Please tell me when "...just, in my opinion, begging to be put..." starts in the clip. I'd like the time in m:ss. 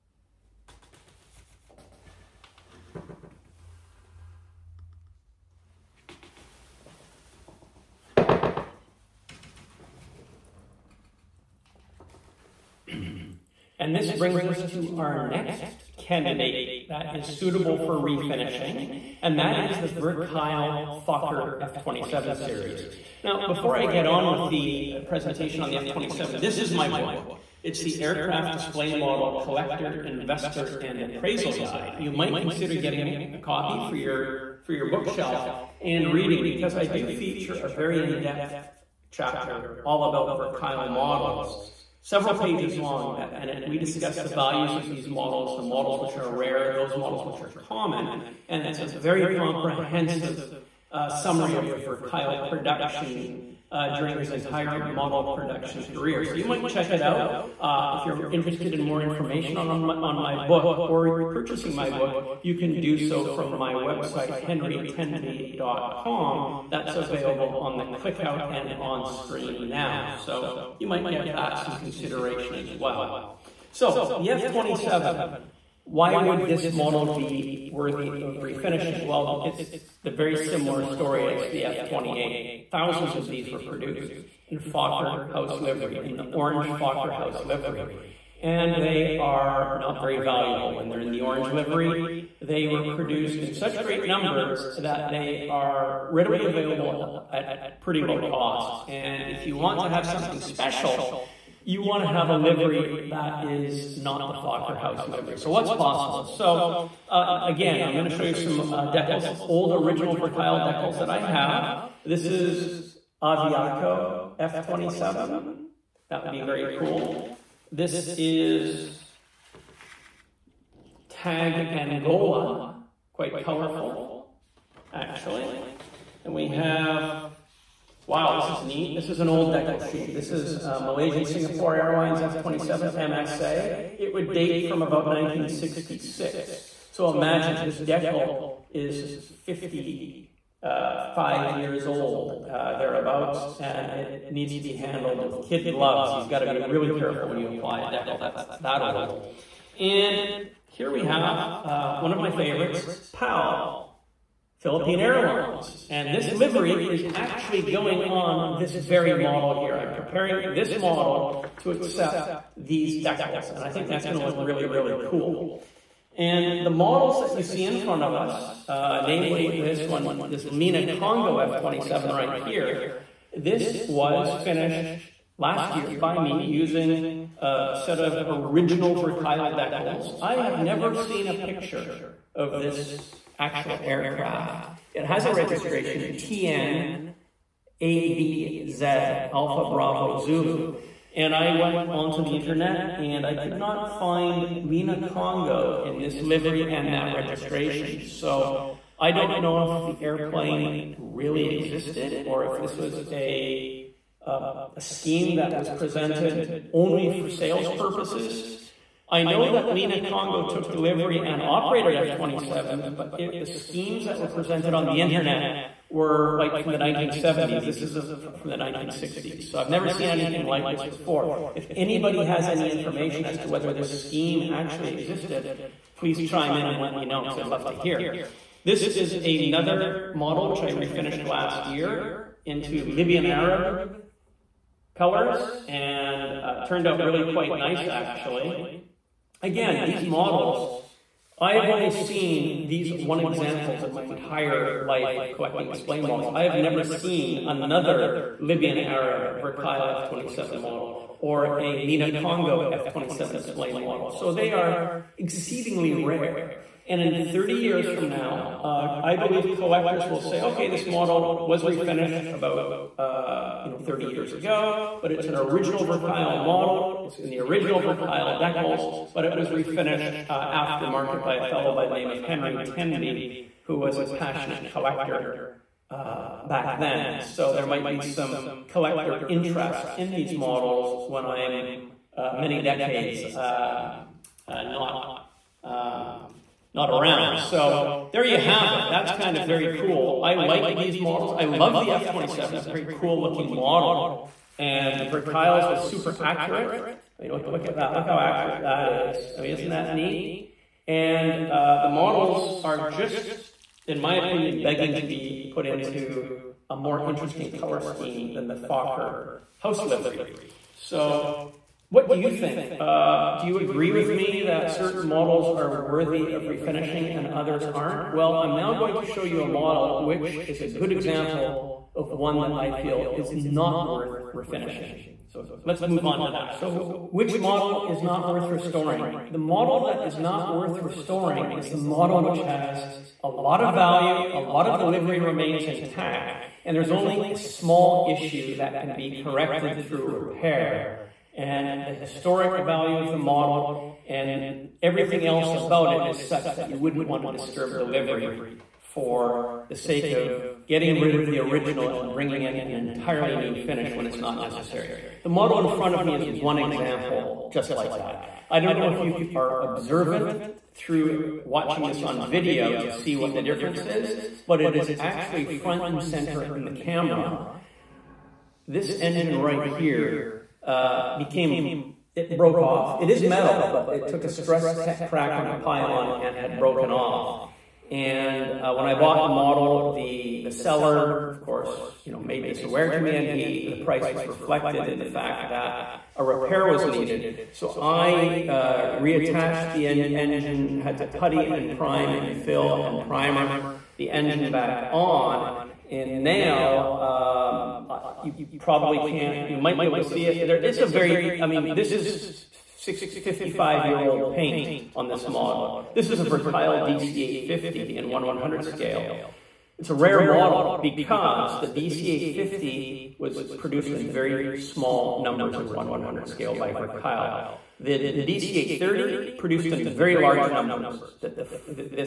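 5:02.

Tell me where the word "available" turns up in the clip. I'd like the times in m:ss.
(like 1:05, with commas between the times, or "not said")
1:06, 1:36.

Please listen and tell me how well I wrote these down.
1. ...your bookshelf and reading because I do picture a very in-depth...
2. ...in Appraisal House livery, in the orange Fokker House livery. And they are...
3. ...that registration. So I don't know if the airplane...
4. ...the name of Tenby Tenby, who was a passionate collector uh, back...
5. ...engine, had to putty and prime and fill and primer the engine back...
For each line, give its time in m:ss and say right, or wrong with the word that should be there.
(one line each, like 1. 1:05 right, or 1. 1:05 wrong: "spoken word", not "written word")
1. 0:34 wrong: "feature", not "picture"
2. 1:24 wrong: "Fokker", not "Appraisal"
3. 3:16 right
4. 4:31 wrong: "Henry", not "Tenby"
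5. 6:30 right.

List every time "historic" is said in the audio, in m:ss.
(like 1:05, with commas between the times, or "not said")
5:41.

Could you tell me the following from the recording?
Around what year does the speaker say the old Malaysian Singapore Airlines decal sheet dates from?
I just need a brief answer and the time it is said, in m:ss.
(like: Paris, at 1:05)
1966, at 2:15.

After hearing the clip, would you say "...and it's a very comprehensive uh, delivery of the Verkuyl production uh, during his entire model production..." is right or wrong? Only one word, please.
wrong.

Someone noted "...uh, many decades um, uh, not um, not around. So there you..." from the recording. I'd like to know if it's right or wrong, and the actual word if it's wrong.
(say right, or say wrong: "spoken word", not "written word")
right.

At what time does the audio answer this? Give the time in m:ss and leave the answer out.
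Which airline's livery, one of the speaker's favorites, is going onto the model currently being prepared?
2:34.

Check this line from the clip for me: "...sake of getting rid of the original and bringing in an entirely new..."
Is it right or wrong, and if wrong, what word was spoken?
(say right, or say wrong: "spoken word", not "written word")
right.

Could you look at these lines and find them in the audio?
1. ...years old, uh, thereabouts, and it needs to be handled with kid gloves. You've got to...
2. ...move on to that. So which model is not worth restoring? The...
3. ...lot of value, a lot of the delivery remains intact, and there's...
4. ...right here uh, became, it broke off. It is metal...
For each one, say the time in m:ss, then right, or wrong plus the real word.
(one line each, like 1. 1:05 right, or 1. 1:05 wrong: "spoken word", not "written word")
1. 2:21 right
2. 5:25 right
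3. 5:33 wrong: "livery", not "delivery"
4. 6:09 right.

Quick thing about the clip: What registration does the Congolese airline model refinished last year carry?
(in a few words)
TN ABZ.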